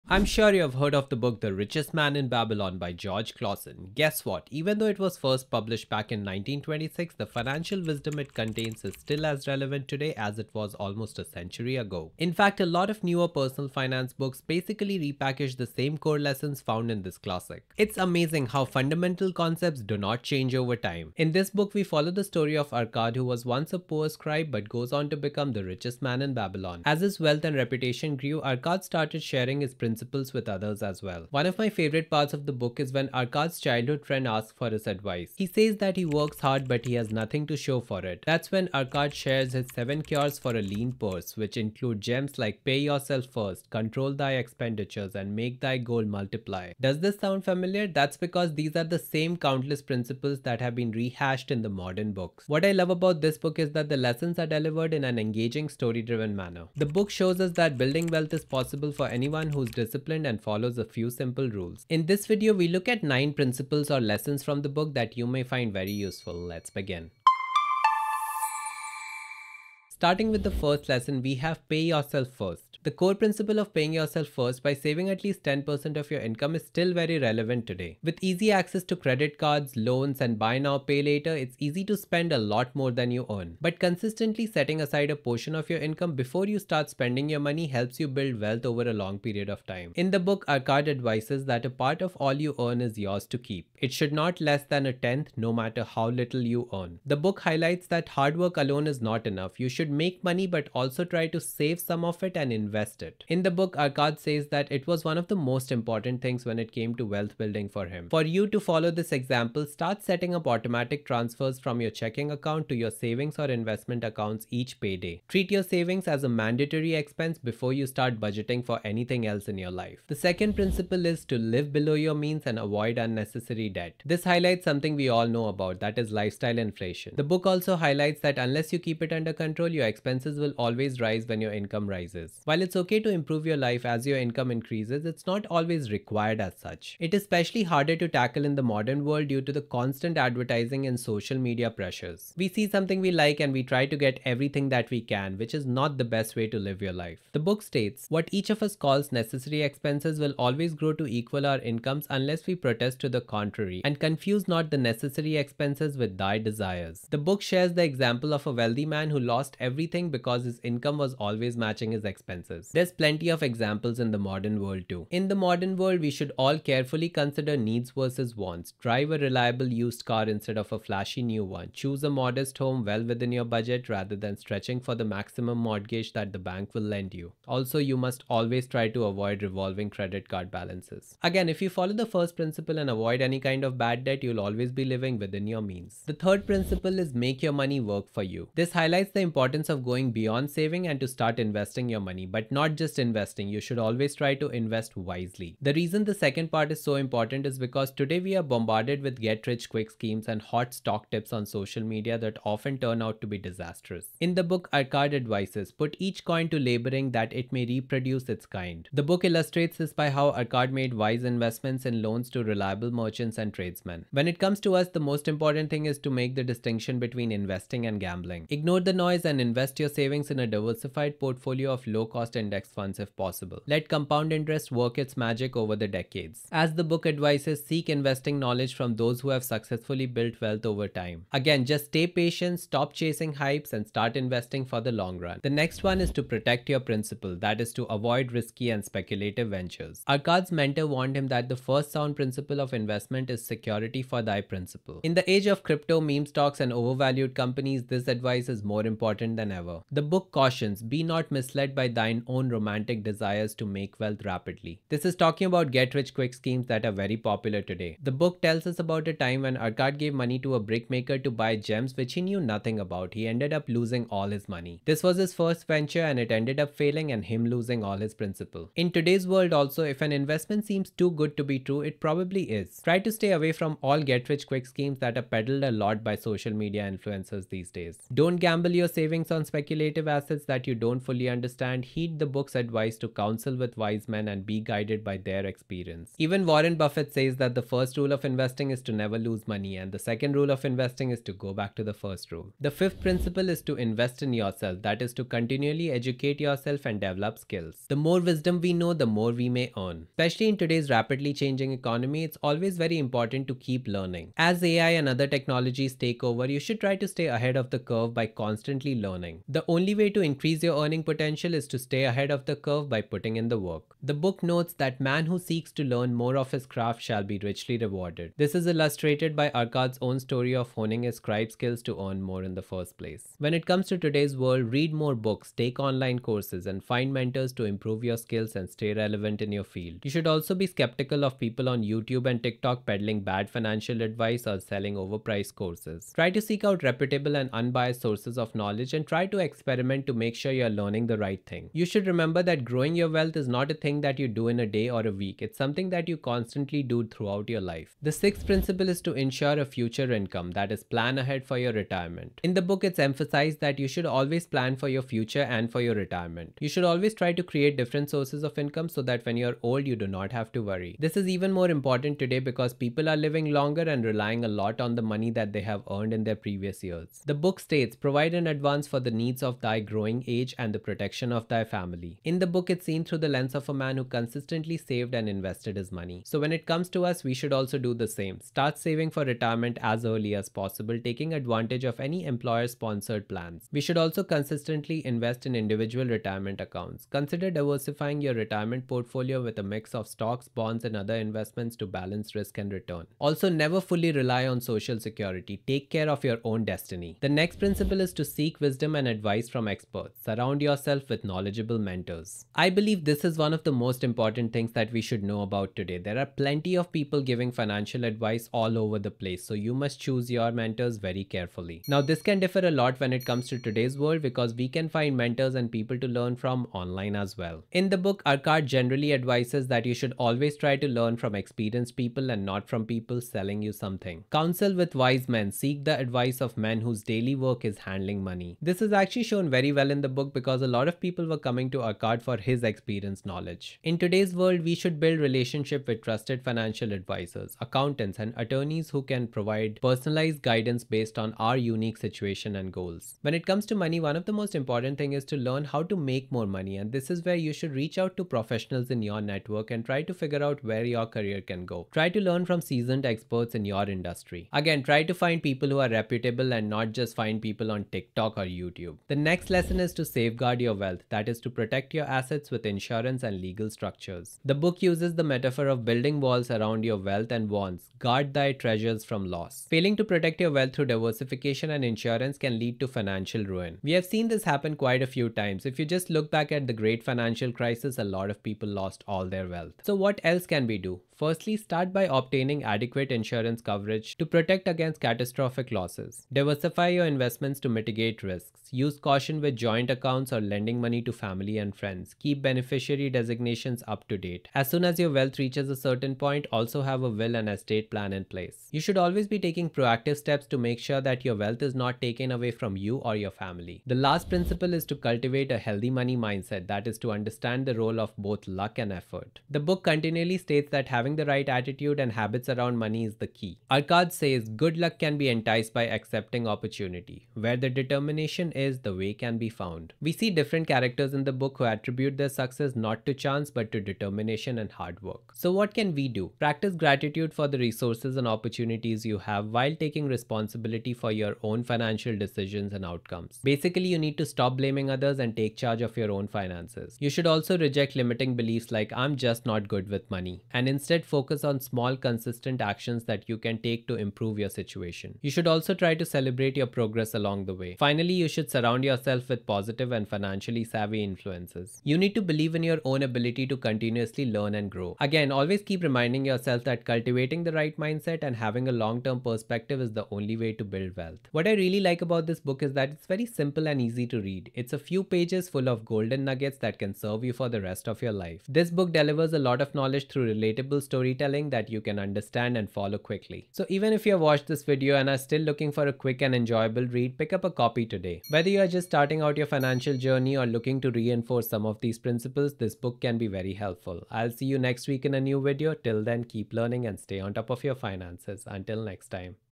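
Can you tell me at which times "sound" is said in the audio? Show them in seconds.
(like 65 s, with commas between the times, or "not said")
47 s, 241 s.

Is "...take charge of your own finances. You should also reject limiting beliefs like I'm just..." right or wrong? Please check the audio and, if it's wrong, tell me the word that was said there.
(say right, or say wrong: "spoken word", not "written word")
right.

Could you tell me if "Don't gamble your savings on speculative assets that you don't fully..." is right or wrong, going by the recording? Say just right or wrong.
right.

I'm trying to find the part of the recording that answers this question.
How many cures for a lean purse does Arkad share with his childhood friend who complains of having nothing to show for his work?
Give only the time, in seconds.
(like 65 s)
39 s.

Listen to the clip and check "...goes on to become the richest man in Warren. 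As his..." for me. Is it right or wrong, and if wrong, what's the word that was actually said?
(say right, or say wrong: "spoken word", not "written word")
wrong: "Babylon", not "Warren".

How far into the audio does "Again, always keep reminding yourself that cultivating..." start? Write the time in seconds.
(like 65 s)
555 s.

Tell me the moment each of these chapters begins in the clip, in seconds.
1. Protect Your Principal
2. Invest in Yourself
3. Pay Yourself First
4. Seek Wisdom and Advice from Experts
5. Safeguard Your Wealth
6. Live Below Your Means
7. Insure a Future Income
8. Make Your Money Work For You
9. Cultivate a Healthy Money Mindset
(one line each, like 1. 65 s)
1. 235 s
2. 292 s
3. 69 s
4. 397 s
5. 459 s
6. 119 s
7. 347 s
8. 186 s
9. 503 s.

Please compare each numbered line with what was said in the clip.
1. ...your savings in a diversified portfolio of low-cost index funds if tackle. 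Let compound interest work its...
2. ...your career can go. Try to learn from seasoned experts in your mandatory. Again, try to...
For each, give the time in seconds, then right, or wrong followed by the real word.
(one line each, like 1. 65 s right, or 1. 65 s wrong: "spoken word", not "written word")
1. 219 s wrong: "possible", not "tackle"
2. 450 s wrong: "industry", not "mandatory".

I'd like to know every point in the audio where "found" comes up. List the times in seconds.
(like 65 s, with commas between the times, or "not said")
16 s, 519 s.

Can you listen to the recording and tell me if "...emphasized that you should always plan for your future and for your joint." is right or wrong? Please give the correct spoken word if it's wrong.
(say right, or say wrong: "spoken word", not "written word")
wrong: "retirement", not "joint".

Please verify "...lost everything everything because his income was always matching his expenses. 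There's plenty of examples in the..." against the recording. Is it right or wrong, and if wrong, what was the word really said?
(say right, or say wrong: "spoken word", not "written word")
right.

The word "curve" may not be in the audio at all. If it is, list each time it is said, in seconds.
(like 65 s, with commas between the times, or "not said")
307 s, 312 s.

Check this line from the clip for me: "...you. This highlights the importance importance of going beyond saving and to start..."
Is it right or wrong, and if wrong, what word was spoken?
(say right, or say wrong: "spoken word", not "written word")
right.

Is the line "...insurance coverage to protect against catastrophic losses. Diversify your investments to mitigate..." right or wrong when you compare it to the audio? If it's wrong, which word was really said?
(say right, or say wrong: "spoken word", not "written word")
right.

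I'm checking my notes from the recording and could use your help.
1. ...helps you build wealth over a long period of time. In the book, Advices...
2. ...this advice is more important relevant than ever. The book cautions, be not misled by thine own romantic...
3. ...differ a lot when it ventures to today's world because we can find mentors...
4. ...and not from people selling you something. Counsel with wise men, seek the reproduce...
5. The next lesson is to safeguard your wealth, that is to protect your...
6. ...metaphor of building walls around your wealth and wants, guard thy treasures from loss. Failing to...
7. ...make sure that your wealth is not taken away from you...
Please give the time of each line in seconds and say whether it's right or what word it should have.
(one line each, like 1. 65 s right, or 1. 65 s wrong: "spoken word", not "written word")
1. 87 s wrong: "Arkad", not "Advices"
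2. 247 s right
3. 412 s wrong: "comes", not "ventures"
4. 422 s wrong: "advice", not "reproduce"
5. 459 s right
6. 465 s right
7. 500 s right.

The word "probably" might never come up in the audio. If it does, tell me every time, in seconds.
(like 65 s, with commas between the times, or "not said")
271 s.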